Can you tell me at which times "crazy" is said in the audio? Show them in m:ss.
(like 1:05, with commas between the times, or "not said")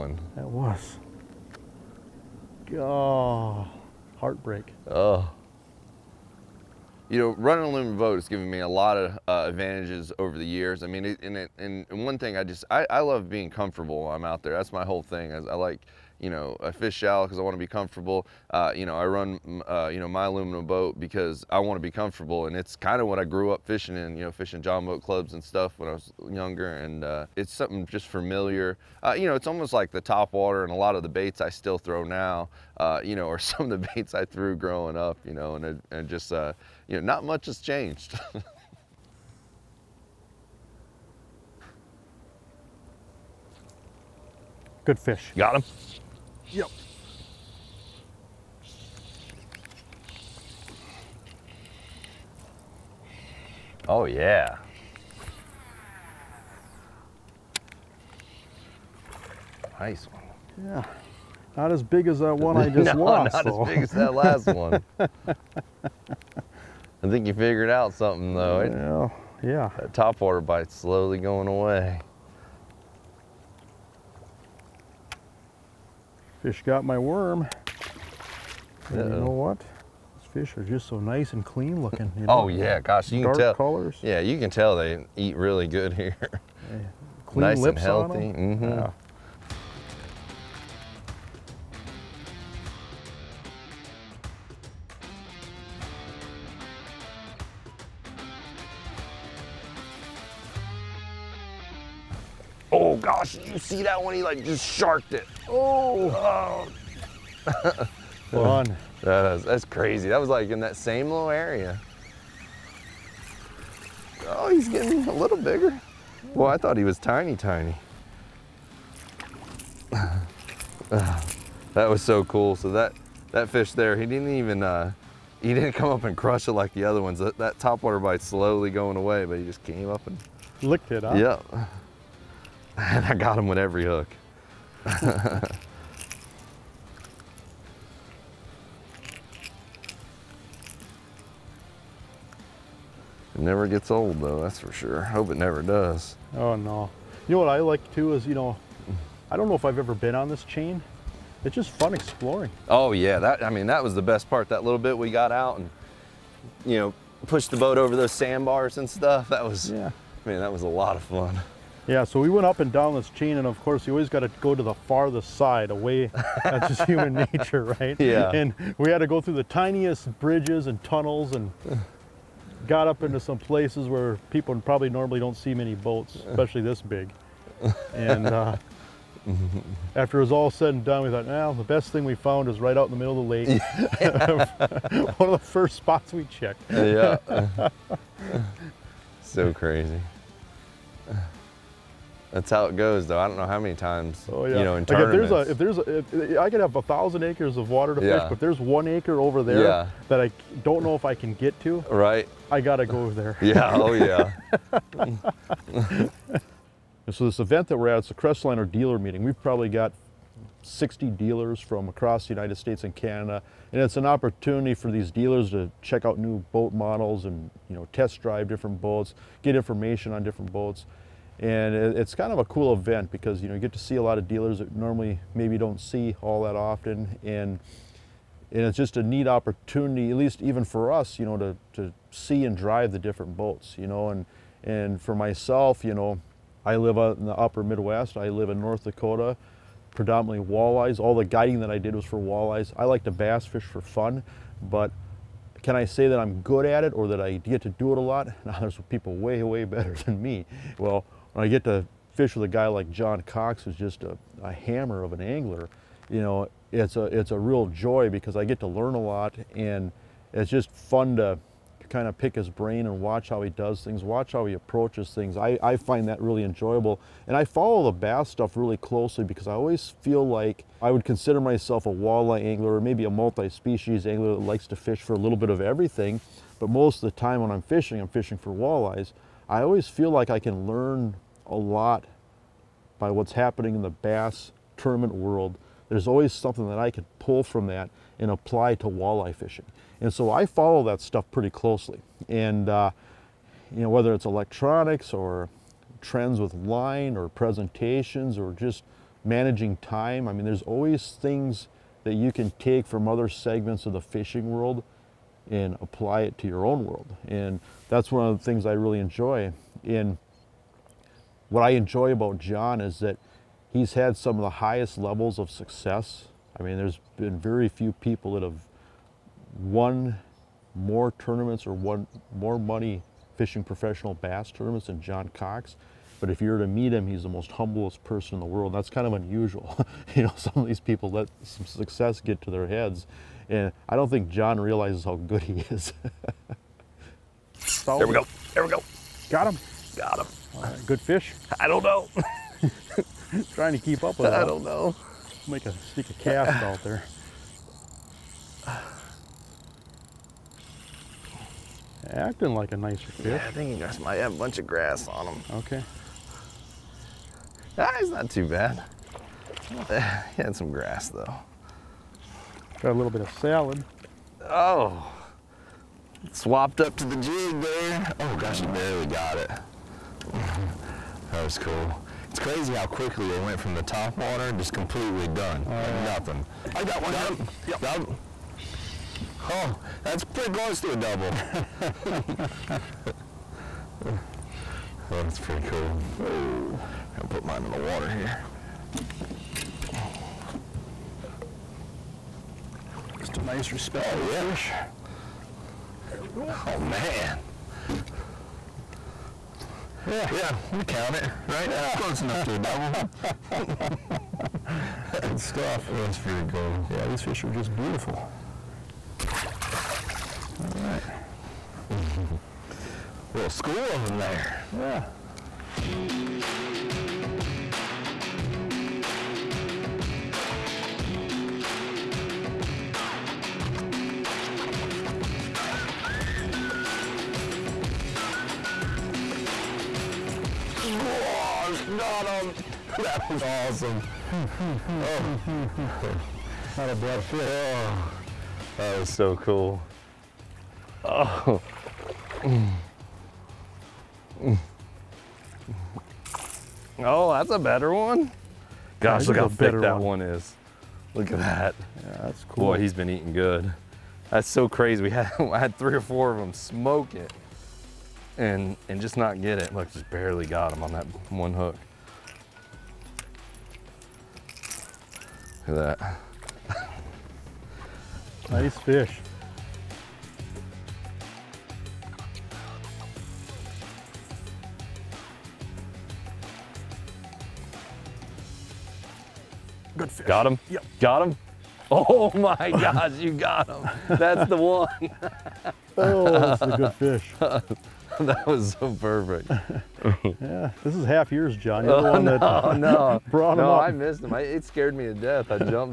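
1:49, 3:09, 6:12, 7:34.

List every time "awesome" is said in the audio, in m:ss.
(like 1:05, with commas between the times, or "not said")
7:13.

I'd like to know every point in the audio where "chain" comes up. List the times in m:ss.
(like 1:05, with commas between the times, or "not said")
2:30, 2:43.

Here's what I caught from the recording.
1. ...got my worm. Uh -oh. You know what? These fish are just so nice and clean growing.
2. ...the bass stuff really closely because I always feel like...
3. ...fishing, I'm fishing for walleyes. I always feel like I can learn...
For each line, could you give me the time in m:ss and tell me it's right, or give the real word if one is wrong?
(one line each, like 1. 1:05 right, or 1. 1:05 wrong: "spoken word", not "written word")
1. 1:16 wrong: "looking", not "growing"
2. 4:27 right
3. 4:37 right.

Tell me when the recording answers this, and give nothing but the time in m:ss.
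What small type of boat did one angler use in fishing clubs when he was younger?
0:24.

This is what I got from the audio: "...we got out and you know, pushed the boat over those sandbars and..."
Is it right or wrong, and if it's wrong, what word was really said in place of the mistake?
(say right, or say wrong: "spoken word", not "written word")
right.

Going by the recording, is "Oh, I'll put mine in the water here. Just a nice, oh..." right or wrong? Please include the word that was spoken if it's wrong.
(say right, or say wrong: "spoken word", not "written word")
right.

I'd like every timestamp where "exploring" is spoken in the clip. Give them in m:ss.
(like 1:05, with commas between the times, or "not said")
2:31.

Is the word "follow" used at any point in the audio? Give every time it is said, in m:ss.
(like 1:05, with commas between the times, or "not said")
4:27, 4:50.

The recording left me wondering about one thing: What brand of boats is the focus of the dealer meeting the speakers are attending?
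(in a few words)
Crestliner.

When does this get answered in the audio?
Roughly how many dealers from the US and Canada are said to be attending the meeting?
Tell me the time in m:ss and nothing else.
3:30.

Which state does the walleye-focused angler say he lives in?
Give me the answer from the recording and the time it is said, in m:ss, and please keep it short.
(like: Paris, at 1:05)
North Dakota, at 3:58.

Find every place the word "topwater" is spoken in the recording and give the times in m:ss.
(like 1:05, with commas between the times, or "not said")
1:09, 2:07.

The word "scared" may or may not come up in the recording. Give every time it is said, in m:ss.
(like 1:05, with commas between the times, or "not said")
8:14.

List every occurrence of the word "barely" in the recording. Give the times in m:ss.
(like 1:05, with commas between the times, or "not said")
6:08, 7:40.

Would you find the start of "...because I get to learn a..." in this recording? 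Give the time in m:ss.
4:18.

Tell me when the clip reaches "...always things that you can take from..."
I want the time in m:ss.
5:00.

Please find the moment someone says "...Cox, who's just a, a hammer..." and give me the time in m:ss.
4:13.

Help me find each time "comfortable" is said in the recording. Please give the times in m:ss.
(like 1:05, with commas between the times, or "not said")
0:13, 0:17, 0:21.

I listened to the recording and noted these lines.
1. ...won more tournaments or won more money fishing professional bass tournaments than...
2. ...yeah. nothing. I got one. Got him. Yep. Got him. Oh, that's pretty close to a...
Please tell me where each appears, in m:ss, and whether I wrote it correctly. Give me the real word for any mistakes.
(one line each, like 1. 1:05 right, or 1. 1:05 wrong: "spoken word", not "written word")
1. 5:19 right
2. 6:15 right.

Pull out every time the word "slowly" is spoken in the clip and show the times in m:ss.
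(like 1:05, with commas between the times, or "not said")
1:10, 2:08.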